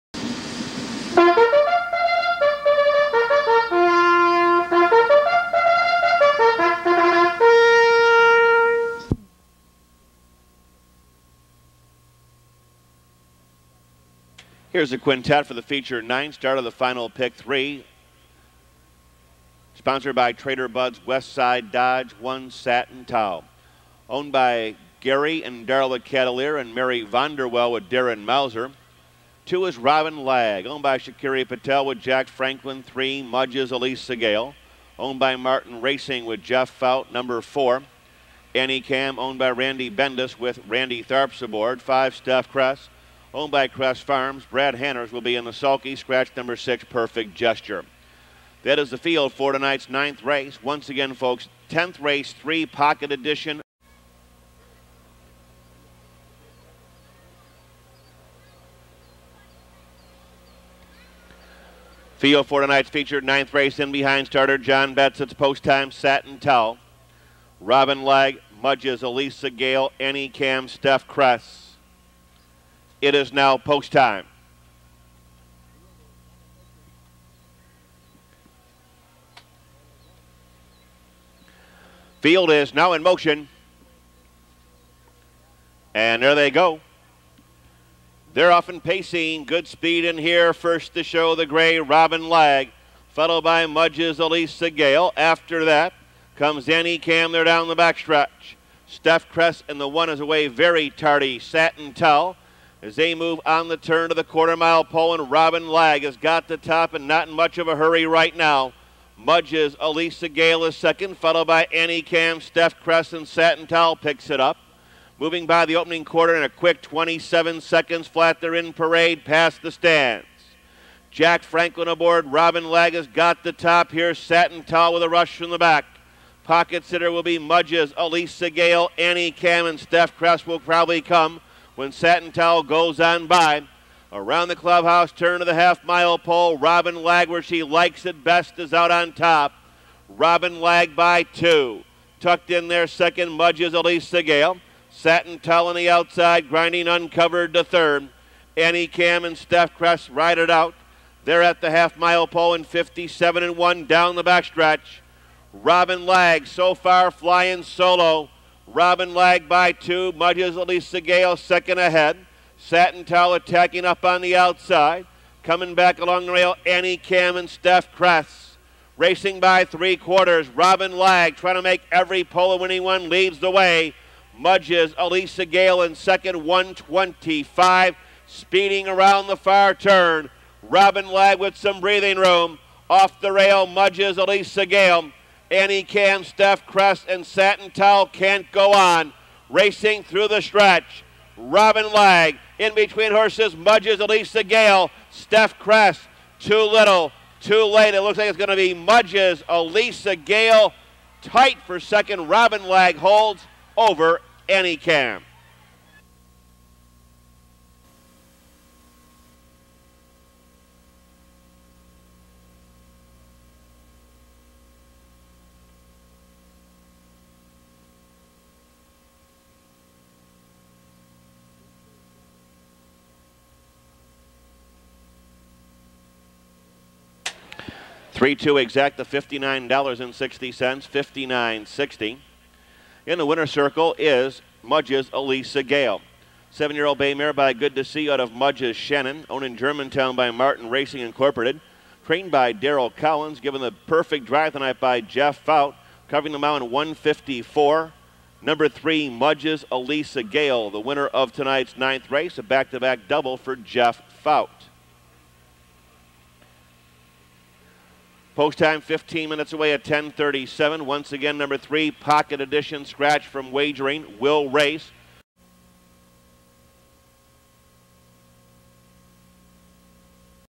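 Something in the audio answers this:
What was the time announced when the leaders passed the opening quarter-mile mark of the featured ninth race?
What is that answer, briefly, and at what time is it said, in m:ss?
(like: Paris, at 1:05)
27 seconds flat, at 1:56.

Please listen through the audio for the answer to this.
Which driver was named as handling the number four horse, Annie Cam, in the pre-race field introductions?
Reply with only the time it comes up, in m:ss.
0:40.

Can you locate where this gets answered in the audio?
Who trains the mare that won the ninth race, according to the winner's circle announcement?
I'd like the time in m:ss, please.
4:02.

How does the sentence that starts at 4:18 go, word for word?
Post time 15 minutes away at 10:37.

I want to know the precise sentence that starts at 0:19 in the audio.
Sponsored by Trader Bud's Westside Dodge One Satin Towel.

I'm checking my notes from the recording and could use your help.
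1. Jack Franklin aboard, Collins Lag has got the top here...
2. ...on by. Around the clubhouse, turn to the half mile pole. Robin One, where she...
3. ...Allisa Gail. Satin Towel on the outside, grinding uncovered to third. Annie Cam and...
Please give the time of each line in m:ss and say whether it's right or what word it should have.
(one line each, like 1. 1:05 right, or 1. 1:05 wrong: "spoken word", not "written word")
1. 2:01 wrong: "Robin", not "Collins"
2. 2:12 wrong: "Lag", not "One"
3. 2:23 right.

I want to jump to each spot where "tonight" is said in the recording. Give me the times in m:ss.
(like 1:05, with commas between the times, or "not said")
0:49, 1:02, 4:04, 4:11.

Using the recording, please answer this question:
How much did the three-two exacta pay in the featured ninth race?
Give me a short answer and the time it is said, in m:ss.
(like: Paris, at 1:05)
$59.60, at 3:49.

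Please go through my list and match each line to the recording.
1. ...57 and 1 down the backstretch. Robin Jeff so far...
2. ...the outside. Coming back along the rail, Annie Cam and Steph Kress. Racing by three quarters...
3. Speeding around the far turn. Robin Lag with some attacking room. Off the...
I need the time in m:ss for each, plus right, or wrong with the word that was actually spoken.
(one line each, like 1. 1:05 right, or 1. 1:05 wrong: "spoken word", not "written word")
1. 2:32 wrong: "Lag", not "Jeff"
2. 2:44 right
3. 2:58 wrong: "breathing", not "attacking".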